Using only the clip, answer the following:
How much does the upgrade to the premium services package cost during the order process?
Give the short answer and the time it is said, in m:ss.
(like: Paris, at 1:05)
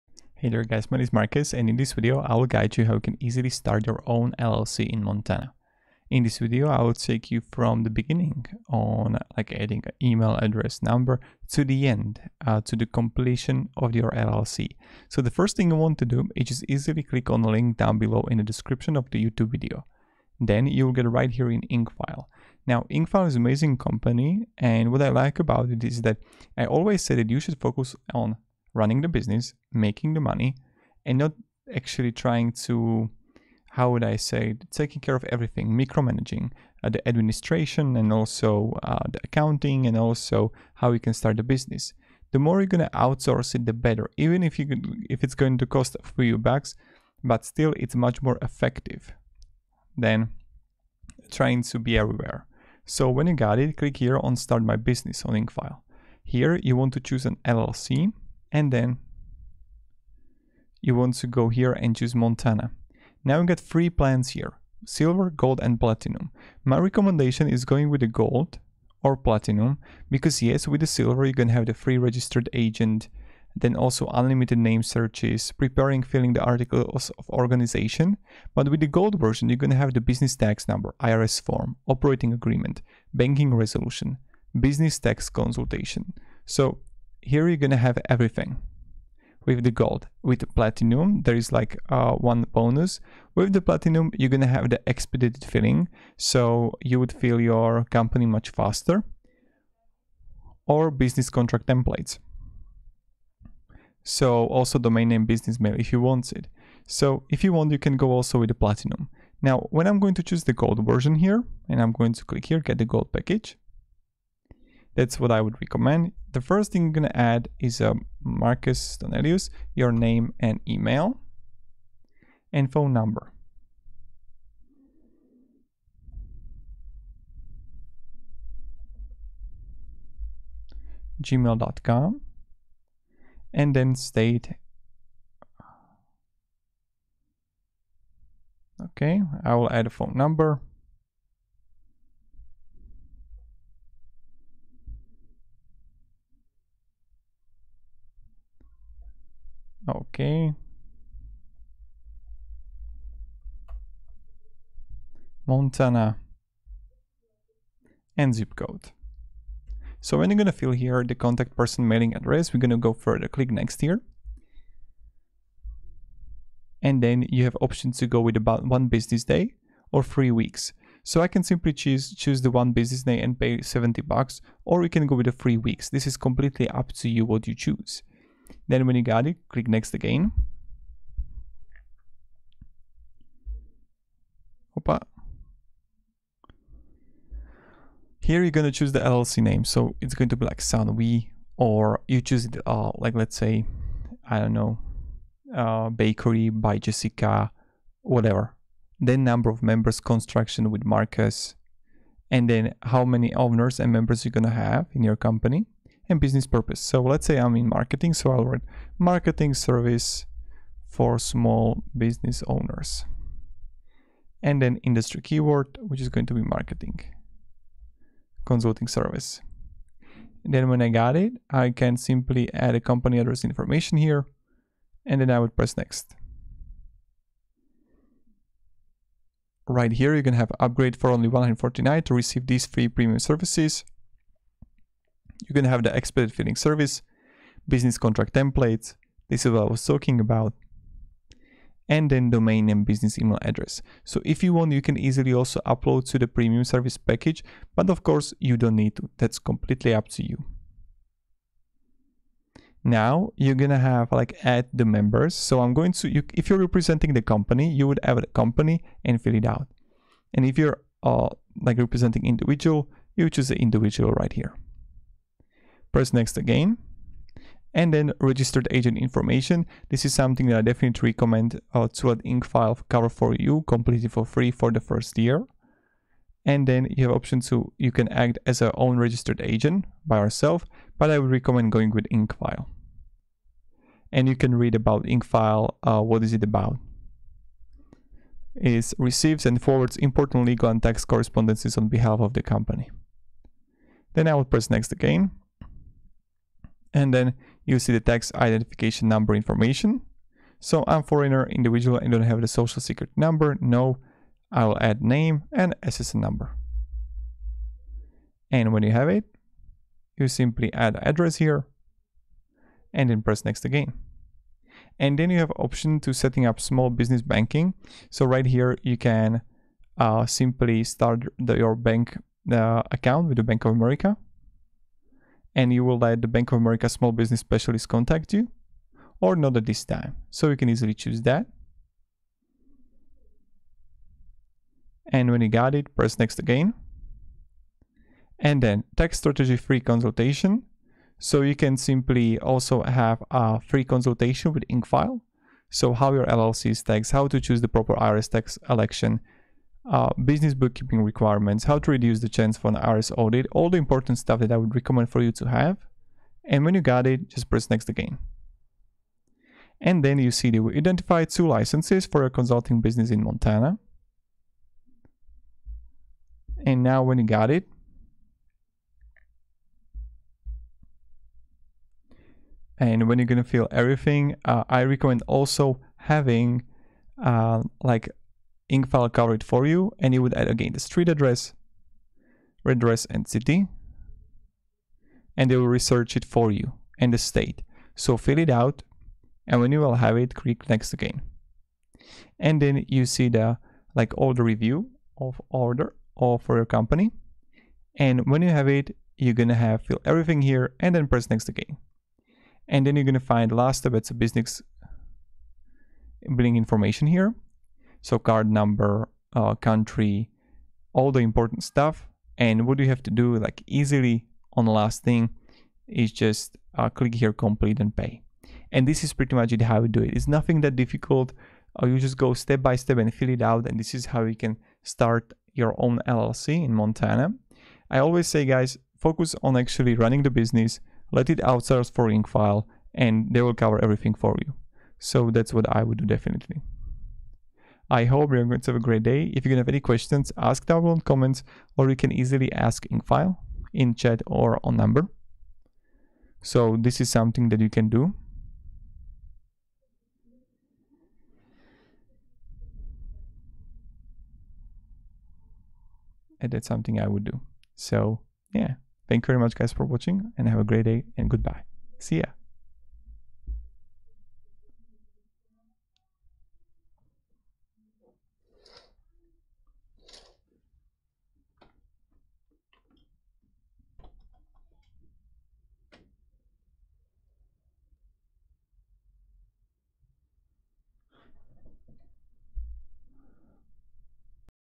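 $149, at 3:51.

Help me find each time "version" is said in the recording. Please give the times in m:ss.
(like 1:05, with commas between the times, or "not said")
1:19, 1:50.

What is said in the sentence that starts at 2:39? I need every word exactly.
So when you're going to fill here the contact person mailing address, we're going to go further, click next here.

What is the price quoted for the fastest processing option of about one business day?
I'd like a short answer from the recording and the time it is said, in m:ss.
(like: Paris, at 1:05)
$70, at 2:53.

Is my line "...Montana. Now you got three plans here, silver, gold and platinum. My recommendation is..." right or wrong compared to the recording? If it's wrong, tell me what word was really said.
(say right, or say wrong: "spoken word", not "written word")
right.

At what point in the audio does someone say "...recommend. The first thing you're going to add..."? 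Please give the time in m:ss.
1:55.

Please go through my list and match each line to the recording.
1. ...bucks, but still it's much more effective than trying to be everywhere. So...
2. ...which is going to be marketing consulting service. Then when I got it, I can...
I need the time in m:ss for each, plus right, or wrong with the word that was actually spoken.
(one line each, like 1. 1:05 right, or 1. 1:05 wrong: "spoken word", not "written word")
1. 0:46 right
2. 3:35 right.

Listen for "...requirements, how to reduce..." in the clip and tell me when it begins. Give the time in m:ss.
5:51.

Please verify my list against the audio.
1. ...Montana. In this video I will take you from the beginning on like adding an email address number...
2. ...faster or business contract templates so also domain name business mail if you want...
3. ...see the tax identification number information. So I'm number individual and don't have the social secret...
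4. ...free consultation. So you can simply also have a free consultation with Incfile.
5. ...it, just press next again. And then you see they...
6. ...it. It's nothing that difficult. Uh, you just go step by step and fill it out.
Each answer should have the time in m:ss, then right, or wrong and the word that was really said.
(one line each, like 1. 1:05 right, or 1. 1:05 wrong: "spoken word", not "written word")
1. 0:05 right
2. 1:38 right
3. 4:57 wrong: "foreigner", not "number"
4. 5:39 right
5. 5:57 right
6. 7:00 right.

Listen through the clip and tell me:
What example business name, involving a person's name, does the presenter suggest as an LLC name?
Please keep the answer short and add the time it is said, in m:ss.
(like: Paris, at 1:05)
Bakery by Jessica, at 3:15.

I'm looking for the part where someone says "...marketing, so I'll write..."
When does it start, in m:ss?
3:27.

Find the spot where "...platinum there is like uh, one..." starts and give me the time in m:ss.
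1:30.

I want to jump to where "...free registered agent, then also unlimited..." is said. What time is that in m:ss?
1:11.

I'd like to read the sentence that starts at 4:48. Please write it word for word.
It receives and forwards important legal and tax correspondences on behalf of the company.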